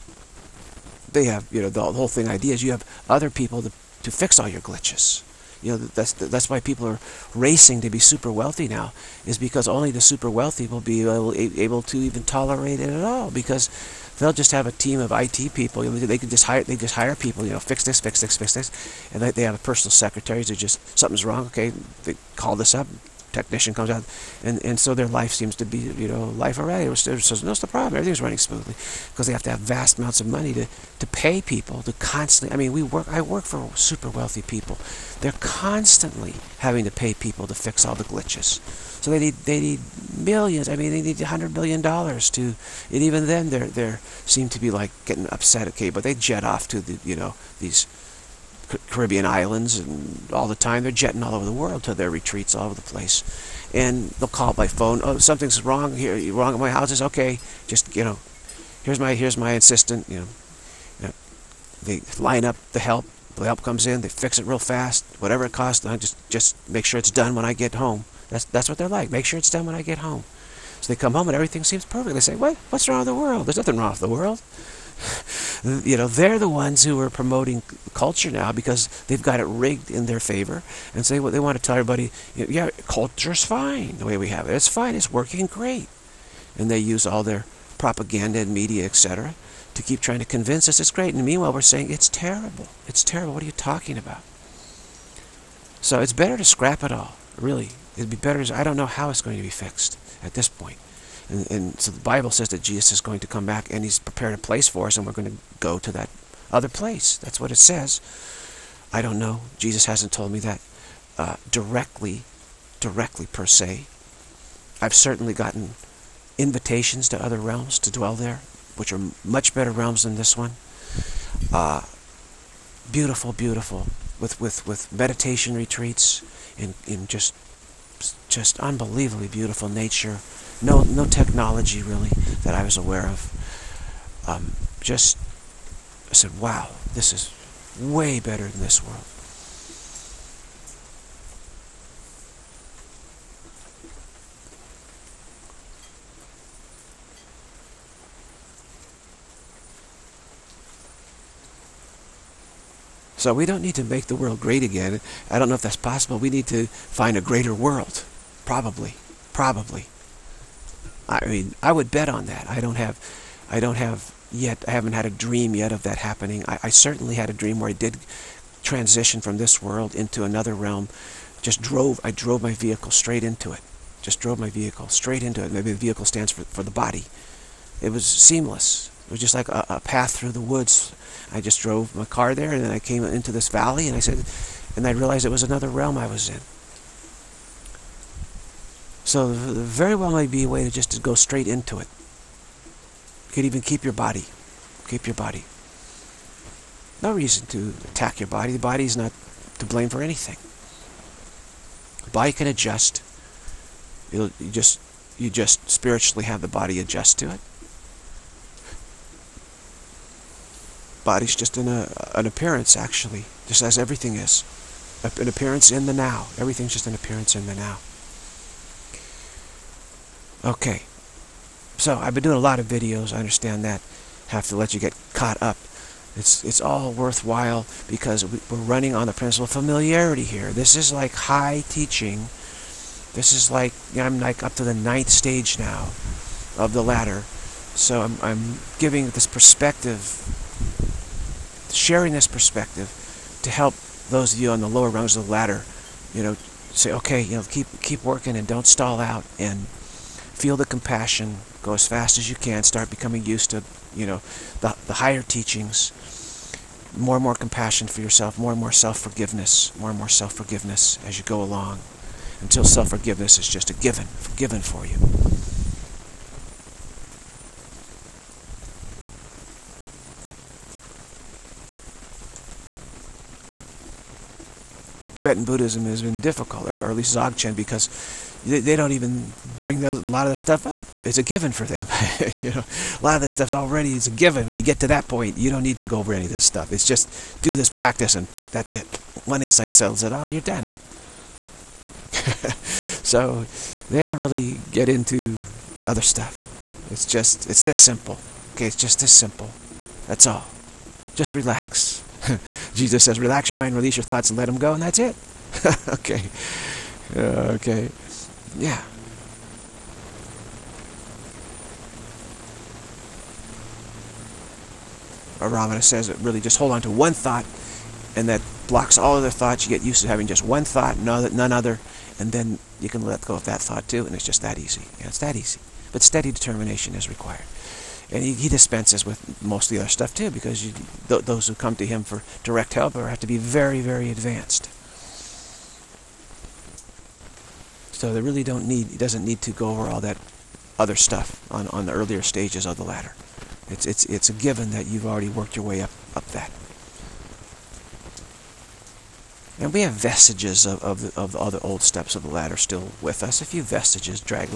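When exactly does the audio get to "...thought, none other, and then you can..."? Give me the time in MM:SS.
05:20.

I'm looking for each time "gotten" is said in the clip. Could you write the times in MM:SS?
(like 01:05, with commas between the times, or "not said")
01:55.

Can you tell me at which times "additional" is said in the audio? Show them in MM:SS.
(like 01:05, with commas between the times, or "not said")
not said.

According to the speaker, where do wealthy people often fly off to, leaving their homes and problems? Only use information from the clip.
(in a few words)
Caribbean islands.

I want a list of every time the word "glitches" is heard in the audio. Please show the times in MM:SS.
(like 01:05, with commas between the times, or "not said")
00:04, 00:38.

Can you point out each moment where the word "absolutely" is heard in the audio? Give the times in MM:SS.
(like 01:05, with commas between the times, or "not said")
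not said.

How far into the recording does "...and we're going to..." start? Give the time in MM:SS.
01:44.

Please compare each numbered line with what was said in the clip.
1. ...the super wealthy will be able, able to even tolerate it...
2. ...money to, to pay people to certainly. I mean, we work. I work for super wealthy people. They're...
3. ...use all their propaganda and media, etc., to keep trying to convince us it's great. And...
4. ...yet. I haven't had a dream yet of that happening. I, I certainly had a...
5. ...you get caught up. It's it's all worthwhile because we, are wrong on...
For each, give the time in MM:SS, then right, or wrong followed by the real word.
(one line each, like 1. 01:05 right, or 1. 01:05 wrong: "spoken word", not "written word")
1. 00:09 right
2. 00:30 wrong: "constantly", not "certainly"
3. 01:26 right
4. 02:44 right
5. 03:44 wrong: "running", not "wrong".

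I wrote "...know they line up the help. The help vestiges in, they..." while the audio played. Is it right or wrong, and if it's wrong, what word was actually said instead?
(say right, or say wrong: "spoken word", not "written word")
wrong: "comes", not "vestiges".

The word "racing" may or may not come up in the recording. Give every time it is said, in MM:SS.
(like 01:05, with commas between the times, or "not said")
00:07.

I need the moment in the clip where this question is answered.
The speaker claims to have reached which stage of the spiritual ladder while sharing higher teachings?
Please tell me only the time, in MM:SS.
03:54.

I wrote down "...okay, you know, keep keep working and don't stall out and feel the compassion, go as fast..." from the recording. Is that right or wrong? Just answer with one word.
right.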